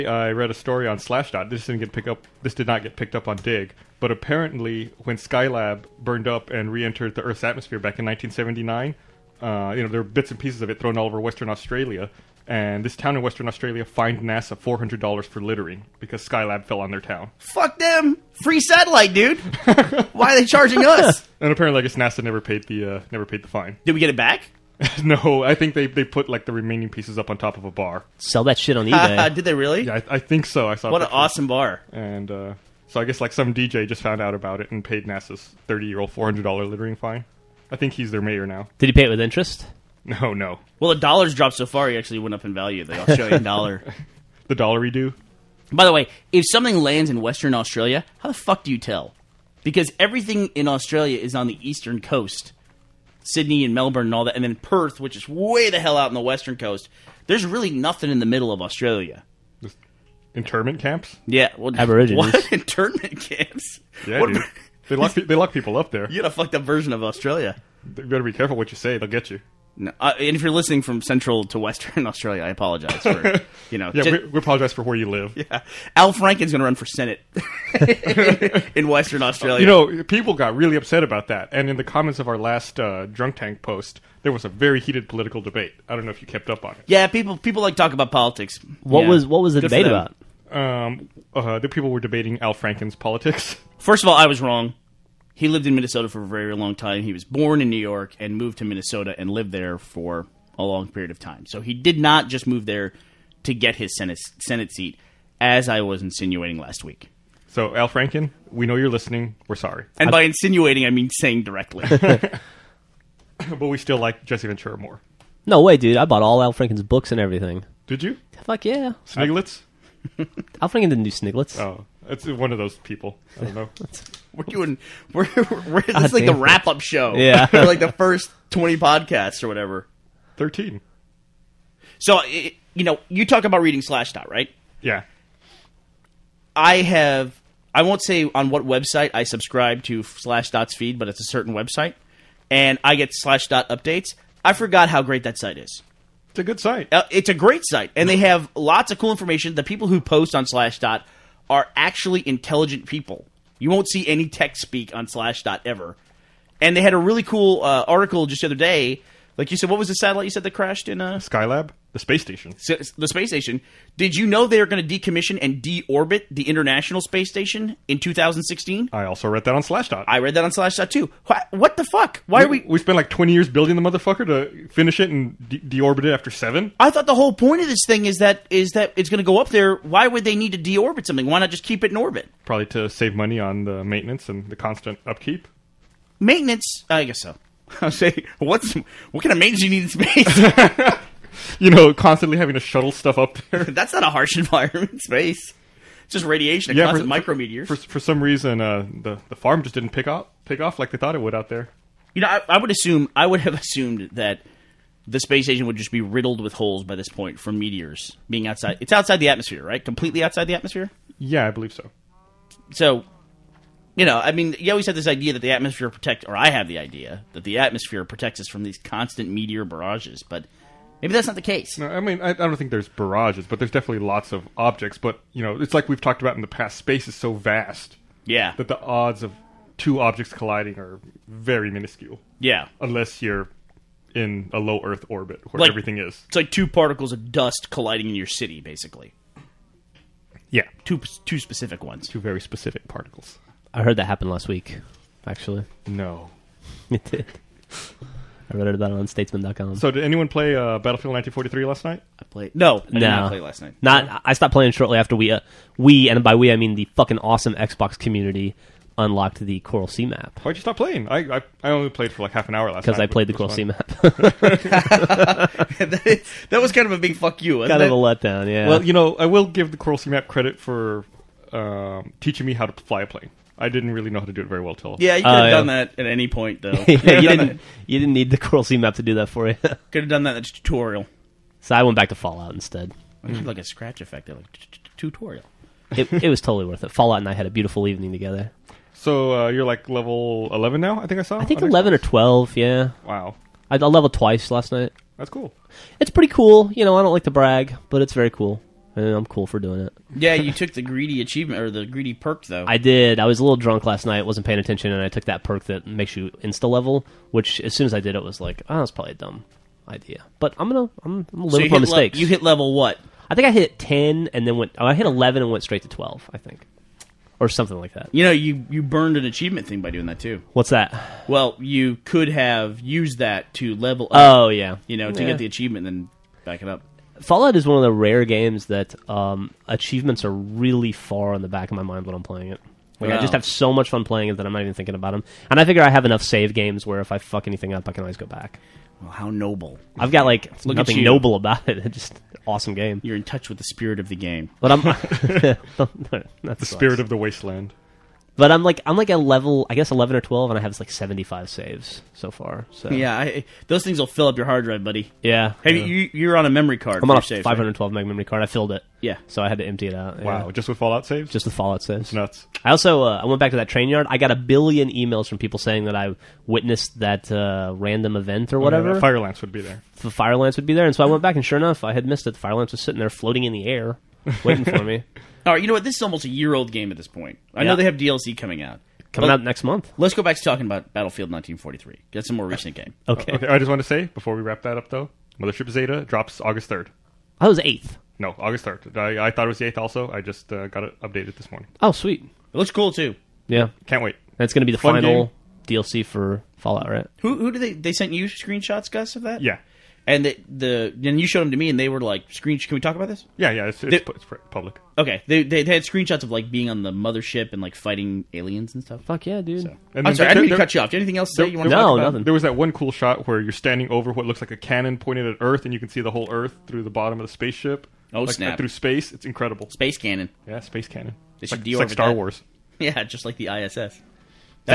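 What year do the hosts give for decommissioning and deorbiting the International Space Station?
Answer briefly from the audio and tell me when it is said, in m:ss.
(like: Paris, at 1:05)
2016, at 2:47.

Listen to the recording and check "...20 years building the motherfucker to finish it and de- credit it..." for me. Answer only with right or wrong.
wrong.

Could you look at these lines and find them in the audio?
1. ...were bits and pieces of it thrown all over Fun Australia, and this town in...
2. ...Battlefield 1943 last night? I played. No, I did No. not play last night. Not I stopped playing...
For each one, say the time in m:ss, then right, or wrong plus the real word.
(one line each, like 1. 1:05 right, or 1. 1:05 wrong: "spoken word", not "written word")
1. 0:10 wrong: "Western", not "Fun"
2. 4:10 right.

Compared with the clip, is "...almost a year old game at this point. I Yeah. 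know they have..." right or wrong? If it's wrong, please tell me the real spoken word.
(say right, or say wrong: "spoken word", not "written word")
right.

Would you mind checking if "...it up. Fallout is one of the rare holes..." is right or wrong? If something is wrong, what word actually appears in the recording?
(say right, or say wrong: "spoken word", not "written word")
wrong: "games", not "holes".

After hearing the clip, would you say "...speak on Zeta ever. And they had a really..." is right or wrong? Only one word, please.
wrong.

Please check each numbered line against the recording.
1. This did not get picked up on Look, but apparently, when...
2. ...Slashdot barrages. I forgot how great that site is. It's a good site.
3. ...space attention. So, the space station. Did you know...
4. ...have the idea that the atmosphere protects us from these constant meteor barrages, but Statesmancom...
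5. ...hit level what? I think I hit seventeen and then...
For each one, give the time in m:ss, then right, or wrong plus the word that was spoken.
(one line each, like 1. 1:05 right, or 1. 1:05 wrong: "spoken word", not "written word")
1. 0:02 wrong: "Digg", not "Look"
2. 2:23 wrong: "updates", not "barrages"
3. 2:41 wrong: "station", not "attention"
4. 3:36 wrong: "Maybe", not "Statesmancom"
5. 5:12 wrong: "ten", not "seventeen".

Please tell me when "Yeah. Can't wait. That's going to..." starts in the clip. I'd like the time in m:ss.
6:33.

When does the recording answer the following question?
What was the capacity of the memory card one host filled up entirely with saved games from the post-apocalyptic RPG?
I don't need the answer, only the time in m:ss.
5:57.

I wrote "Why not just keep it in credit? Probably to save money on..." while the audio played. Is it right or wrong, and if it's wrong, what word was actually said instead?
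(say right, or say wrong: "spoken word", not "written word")
wrong: "orbit", not "credit".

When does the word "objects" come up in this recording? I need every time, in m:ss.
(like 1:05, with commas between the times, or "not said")
3:44, 3:49.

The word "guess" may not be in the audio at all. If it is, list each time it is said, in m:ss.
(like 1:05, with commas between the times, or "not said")
0:21, 0:33, 3:07, 5:49.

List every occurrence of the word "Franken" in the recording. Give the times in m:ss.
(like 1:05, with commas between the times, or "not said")
1:16, 1:32, 1:47, 1:56, 2:00.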